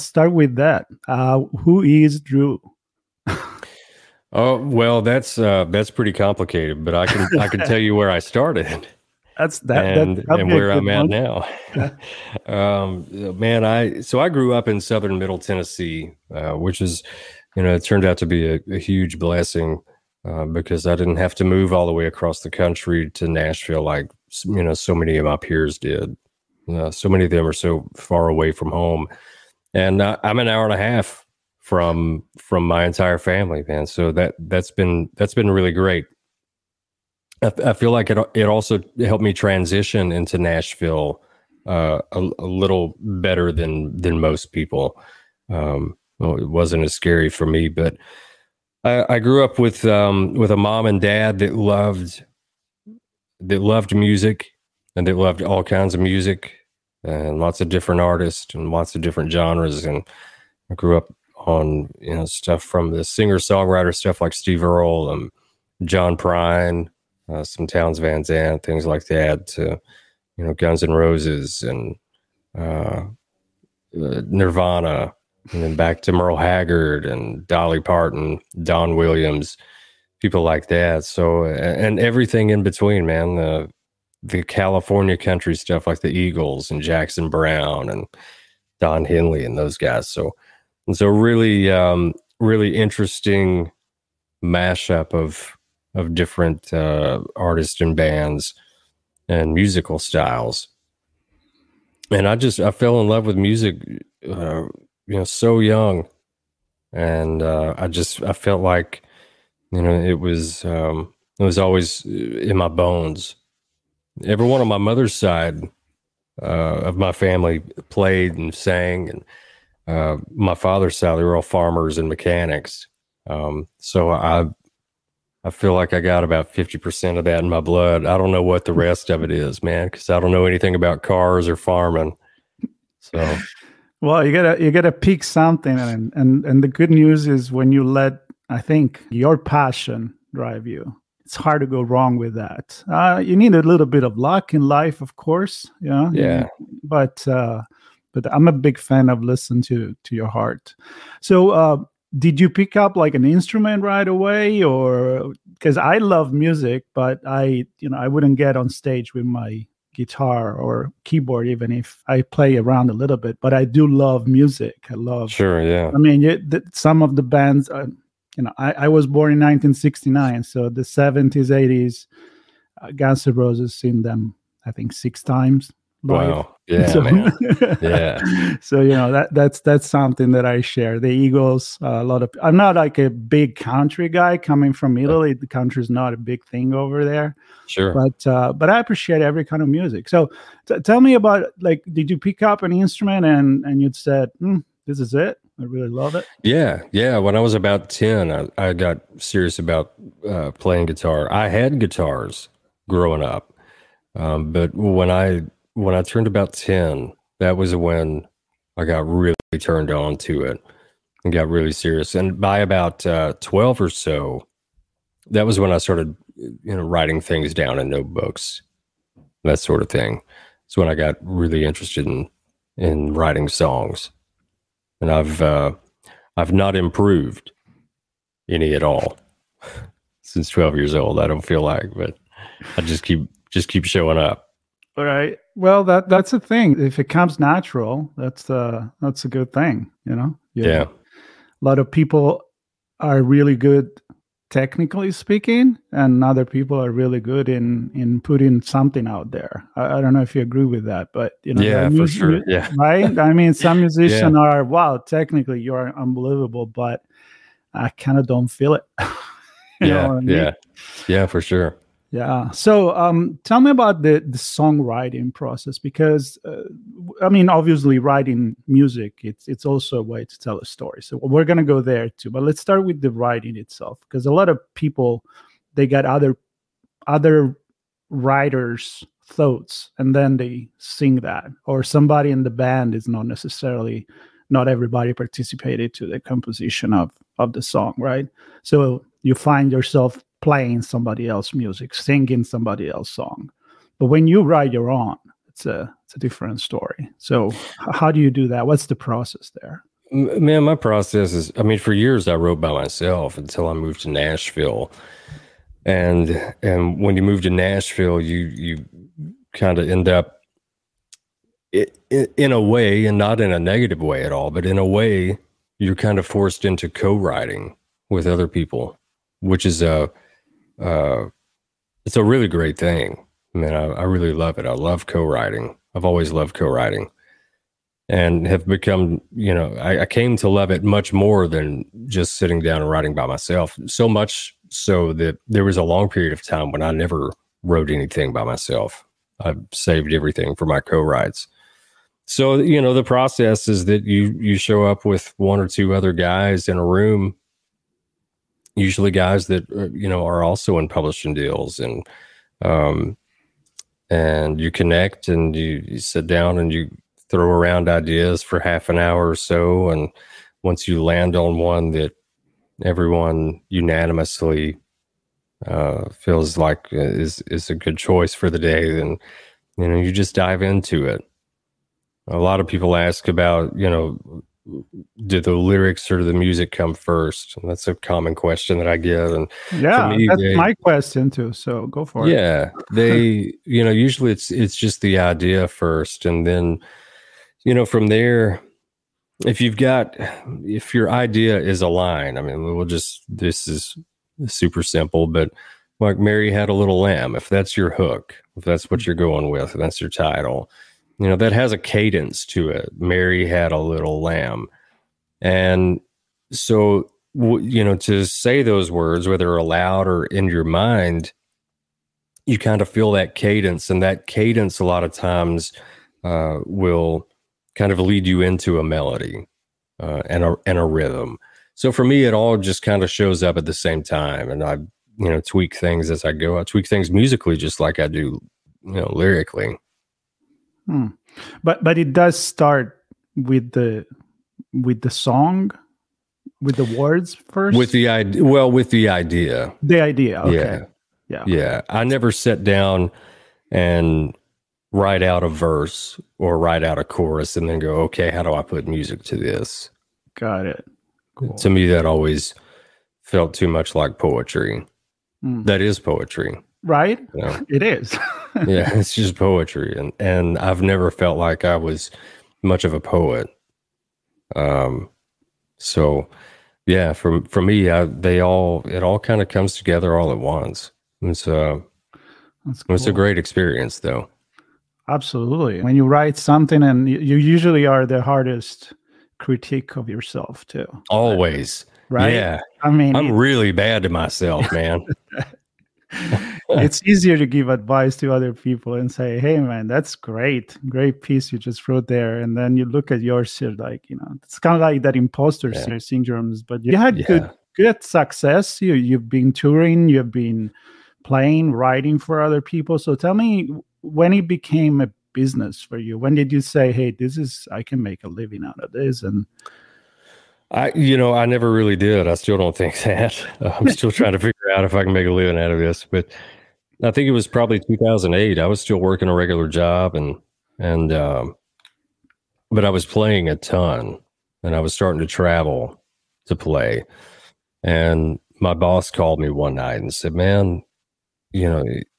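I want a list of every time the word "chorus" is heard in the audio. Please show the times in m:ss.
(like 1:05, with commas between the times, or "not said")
7:27.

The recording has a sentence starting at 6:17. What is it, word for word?
And that's a common question that I get.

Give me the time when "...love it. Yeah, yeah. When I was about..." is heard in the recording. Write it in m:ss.
3:15.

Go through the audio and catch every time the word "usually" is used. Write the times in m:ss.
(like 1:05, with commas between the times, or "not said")
5:48, 6:23, 7:57.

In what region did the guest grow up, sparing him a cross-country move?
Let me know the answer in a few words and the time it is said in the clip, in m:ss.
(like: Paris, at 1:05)
Southern Middle Tennessee, at 0:14.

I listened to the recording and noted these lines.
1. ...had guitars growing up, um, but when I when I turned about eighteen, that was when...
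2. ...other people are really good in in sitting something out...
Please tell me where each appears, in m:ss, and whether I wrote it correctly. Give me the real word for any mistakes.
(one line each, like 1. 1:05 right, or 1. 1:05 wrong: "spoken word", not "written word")
1. 3:21 wrong: "ten", not "eighteen"
2. 4:06 wrong: "putting", not "sitting".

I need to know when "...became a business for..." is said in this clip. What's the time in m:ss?
8:24.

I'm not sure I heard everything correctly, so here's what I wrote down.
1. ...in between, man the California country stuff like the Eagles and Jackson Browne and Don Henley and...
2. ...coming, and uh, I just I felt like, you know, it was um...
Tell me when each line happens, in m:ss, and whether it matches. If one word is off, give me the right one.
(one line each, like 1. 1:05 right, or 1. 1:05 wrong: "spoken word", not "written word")
1. 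1:22 right
2. 1:45 wrong: "young", not "coming".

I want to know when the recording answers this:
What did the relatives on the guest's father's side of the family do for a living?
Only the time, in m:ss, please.
2:01.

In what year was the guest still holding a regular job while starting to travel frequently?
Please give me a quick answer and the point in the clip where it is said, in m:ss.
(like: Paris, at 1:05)
2008, at 8:37.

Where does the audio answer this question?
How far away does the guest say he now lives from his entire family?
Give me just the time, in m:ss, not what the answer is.
0:30.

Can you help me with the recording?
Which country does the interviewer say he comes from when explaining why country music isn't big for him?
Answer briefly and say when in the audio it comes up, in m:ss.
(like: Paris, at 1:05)
Italy, at 3:04.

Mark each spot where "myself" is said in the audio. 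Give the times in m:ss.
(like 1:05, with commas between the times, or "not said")
5:02, 5:33, 5:38, 8:04.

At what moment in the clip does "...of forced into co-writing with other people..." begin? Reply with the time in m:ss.
5:16.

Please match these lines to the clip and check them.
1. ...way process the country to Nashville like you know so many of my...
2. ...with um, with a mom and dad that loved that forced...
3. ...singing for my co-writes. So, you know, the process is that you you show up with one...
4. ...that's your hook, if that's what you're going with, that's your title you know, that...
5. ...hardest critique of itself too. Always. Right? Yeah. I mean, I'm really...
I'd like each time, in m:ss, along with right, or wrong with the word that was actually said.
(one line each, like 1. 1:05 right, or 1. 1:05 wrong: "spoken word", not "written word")
1. 0:21 wrong: "across", not "process"
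2. 0:49 wrong: "loved", not "forced"
3. 5:40 wrong: "everything", not "singing"
4. 6:37 right
5. 7:58 wrong: "yourself", not "itself".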